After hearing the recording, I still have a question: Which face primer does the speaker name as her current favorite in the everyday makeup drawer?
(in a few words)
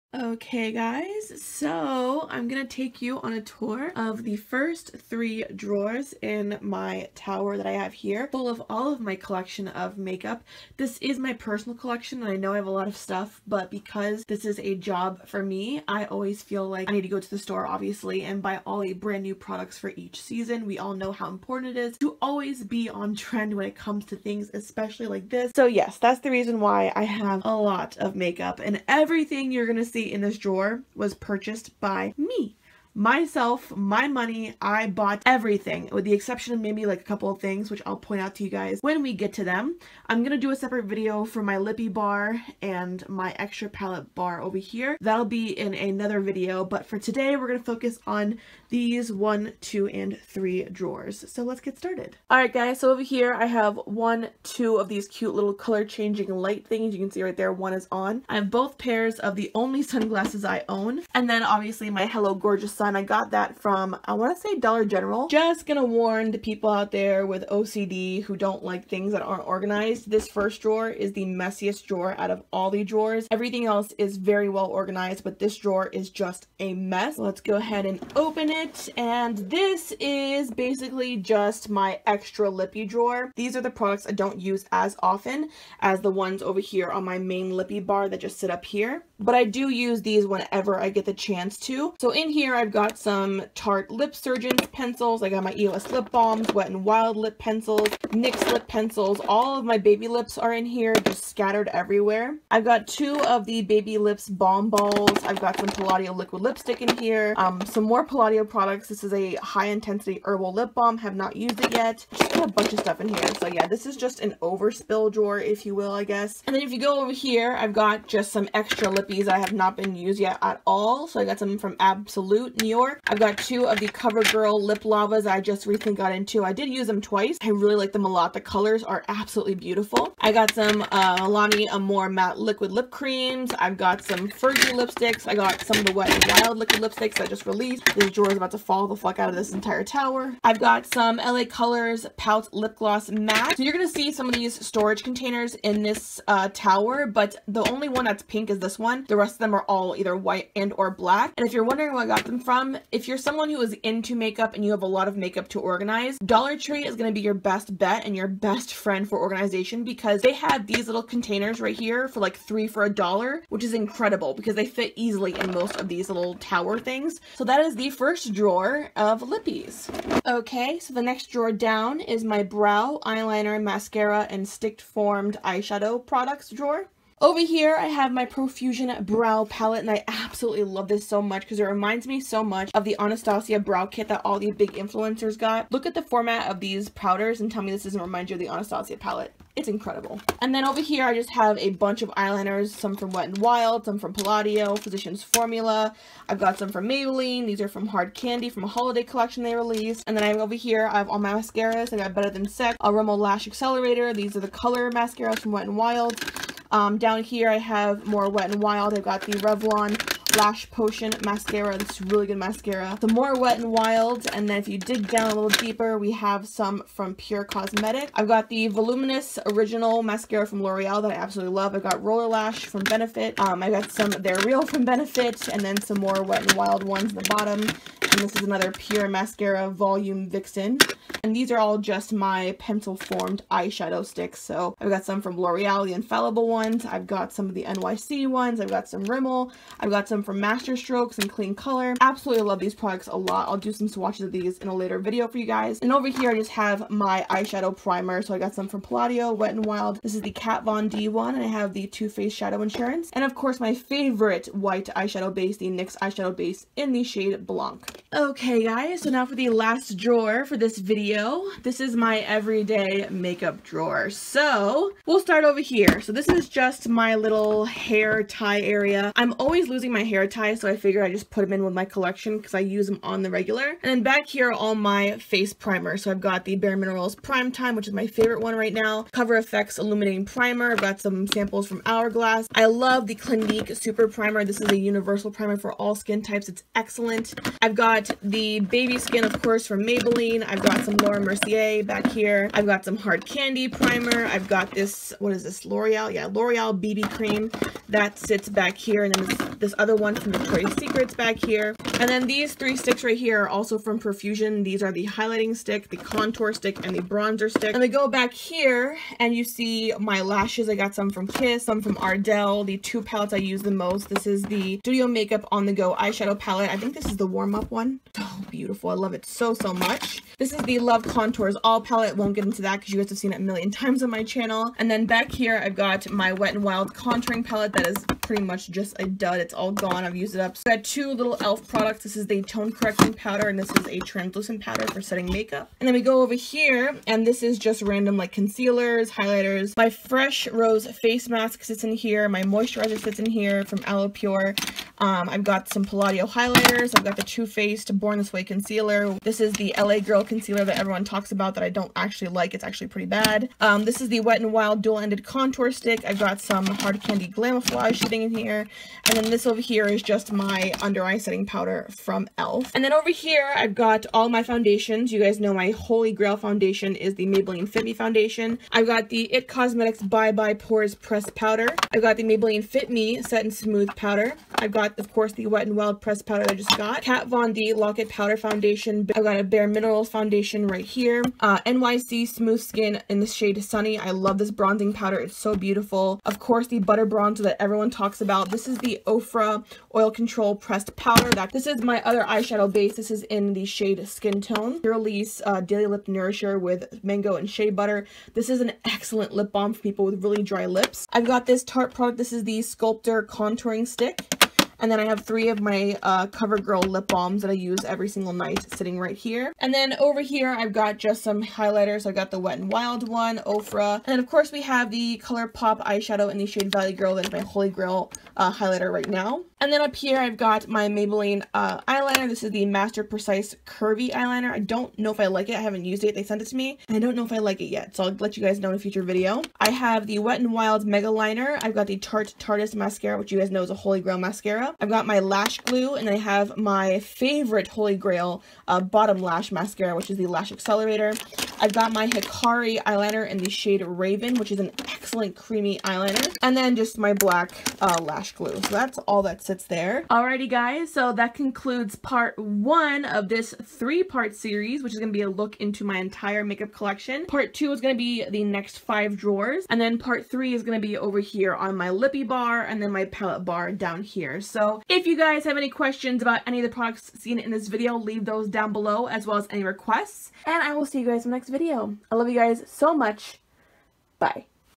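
Bare Minerals Prime Time.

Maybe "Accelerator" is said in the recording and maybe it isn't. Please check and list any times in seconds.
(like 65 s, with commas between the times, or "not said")
203 s, 440 s.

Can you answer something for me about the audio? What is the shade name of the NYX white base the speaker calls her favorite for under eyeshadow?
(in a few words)
Blanc.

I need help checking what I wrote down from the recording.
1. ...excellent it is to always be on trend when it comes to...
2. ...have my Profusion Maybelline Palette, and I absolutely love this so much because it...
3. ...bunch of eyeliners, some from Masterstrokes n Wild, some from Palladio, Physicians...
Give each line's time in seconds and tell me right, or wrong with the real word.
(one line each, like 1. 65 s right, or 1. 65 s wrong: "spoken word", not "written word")
1. 21 s wrong: "important", not "excellent"
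2. 177 s wrong: "Brow", not "Maybelline"
3. 191 s wrong: "Wet", not "Masterstrokes".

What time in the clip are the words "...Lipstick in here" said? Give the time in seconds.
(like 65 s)
106 s.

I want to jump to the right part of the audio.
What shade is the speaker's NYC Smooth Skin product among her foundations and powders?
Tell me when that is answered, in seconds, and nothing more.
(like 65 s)
383 s.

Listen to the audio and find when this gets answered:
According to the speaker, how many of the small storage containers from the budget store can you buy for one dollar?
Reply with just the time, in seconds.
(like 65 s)
162 s.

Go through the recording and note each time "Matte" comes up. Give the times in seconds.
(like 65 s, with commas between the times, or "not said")
132 s, 143 s.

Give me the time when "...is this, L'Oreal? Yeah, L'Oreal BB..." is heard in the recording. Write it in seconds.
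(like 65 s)
295 s.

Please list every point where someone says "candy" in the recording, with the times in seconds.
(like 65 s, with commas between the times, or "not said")
198 s, 293 s, 357 s.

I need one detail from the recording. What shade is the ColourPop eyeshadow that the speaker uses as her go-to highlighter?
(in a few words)
Valley Girl.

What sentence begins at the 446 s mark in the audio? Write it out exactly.
And then just my black uh, lash glue.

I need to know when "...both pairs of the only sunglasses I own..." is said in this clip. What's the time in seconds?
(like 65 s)
58 s.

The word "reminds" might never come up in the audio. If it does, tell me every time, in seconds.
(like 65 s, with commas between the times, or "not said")
181 s, 188 s.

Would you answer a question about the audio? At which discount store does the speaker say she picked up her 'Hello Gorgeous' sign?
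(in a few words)
Dollar General.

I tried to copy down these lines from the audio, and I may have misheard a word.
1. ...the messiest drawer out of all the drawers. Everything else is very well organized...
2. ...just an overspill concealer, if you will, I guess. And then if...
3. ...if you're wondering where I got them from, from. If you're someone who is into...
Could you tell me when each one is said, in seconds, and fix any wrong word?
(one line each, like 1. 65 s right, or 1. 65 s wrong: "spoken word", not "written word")
1. 71 s right
2. 113 s wrong: "drawer", not "concealer"
3. 151 s right.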